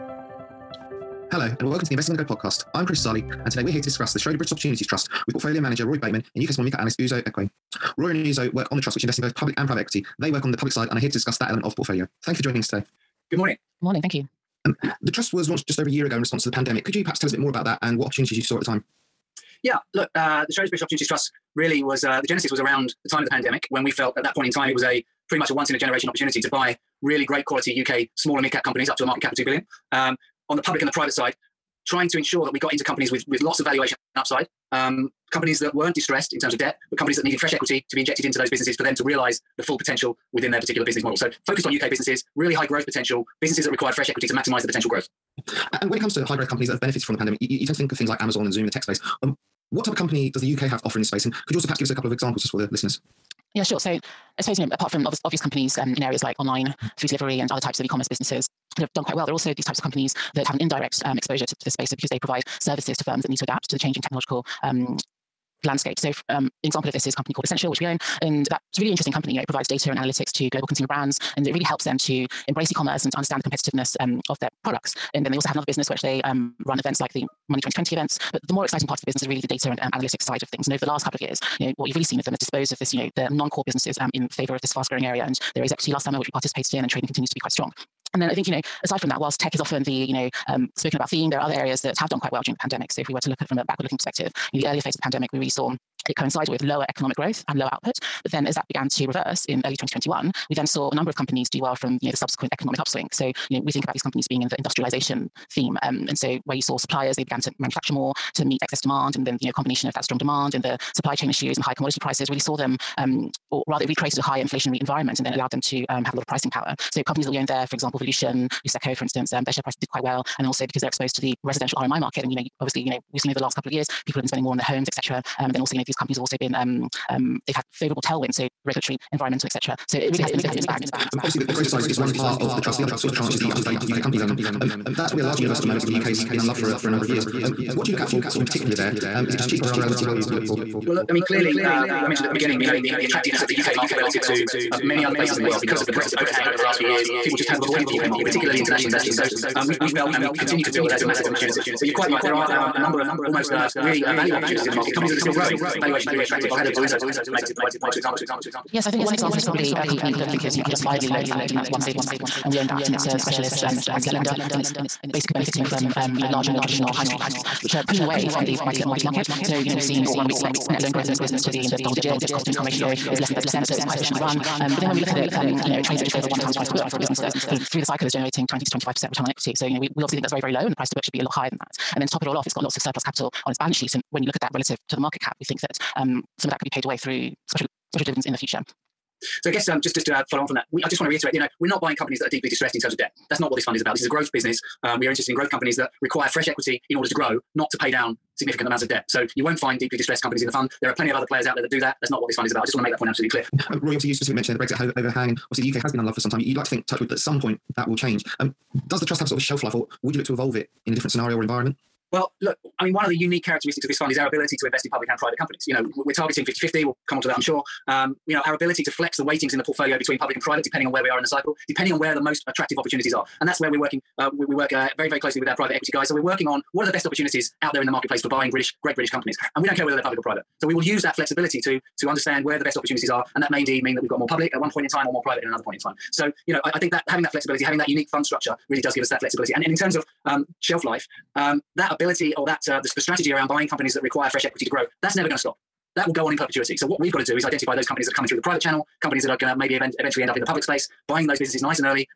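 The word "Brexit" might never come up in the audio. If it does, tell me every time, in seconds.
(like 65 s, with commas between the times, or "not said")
145 s, 204 s.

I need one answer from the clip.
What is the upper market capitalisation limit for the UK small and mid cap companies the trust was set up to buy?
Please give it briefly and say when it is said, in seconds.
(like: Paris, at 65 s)
2 billion, at 29 s.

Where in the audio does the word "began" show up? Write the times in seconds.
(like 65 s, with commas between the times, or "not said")
98 s, 107 s.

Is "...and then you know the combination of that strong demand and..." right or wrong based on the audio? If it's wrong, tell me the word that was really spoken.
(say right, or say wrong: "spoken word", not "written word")
right.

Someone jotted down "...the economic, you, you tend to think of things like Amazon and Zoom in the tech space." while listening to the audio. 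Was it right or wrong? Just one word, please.
wrong.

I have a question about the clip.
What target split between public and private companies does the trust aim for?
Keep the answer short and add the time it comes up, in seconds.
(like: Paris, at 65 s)
50/50, at 216 s.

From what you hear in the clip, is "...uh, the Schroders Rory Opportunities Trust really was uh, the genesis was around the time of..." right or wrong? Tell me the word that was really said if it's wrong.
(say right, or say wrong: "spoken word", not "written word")
wrong: "British", not "Rory".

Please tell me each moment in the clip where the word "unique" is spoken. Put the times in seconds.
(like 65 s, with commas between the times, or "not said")
213 s, 237 s.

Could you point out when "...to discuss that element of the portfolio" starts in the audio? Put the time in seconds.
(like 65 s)
11 s.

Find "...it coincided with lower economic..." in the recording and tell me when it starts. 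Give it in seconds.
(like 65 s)
96 s.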